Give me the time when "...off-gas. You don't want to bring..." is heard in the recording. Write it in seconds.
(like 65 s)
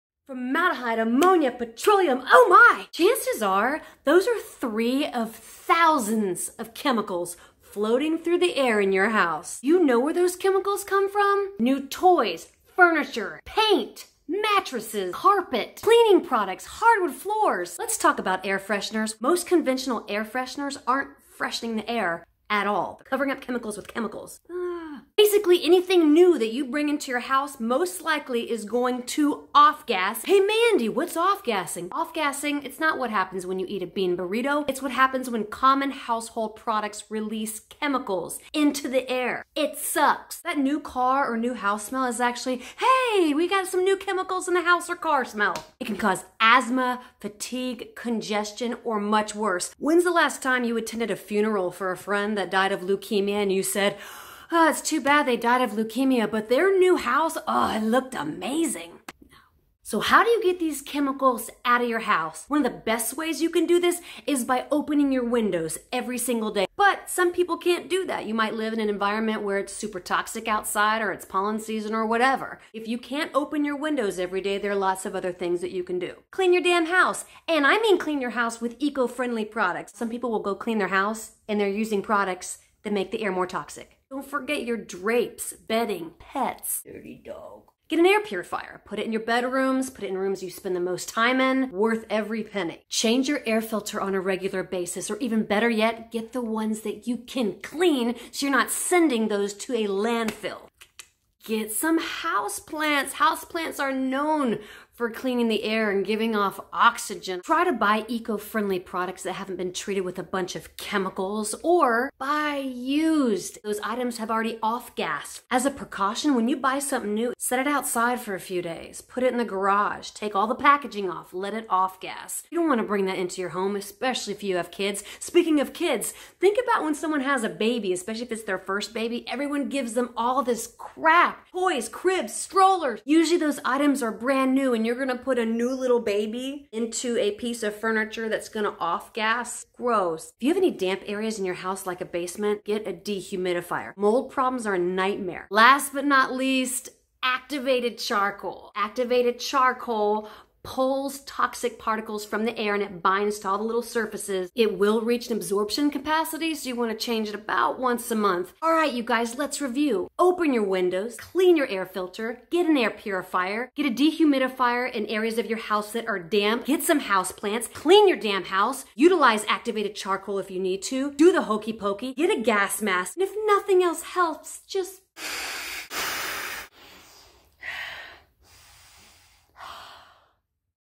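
121 s.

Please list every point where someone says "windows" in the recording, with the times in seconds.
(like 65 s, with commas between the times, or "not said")
65 s, 73 s, 160 s.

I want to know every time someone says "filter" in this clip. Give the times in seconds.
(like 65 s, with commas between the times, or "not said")
93 s, 161 s.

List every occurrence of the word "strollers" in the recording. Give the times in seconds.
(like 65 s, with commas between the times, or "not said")
132 s.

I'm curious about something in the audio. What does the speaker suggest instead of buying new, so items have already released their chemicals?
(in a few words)
buy used.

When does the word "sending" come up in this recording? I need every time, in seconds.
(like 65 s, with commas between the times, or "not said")
98 s.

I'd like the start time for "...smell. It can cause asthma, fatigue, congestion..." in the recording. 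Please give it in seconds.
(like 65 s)
45 s.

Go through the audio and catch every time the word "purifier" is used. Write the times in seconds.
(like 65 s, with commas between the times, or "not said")
88 s, 162 s.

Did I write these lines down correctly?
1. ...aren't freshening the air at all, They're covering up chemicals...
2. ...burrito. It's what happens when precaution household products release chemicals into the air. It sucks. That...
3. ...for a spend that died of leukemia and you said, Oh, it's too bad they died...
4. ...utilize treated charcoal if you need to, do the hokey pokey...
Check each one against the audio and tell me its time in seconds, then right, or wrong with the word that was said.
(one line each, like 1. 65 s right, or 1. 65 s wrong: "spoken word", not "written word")
1. 20 s right
2. 34 s wrong: "common", not "precaution"
3. 51 s wrong: "friend", not "spend"
4. 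168 s wrong: "activated", not "treated".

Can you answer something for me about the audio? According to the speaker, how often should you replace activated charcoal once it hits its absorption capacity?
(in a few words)
once a month.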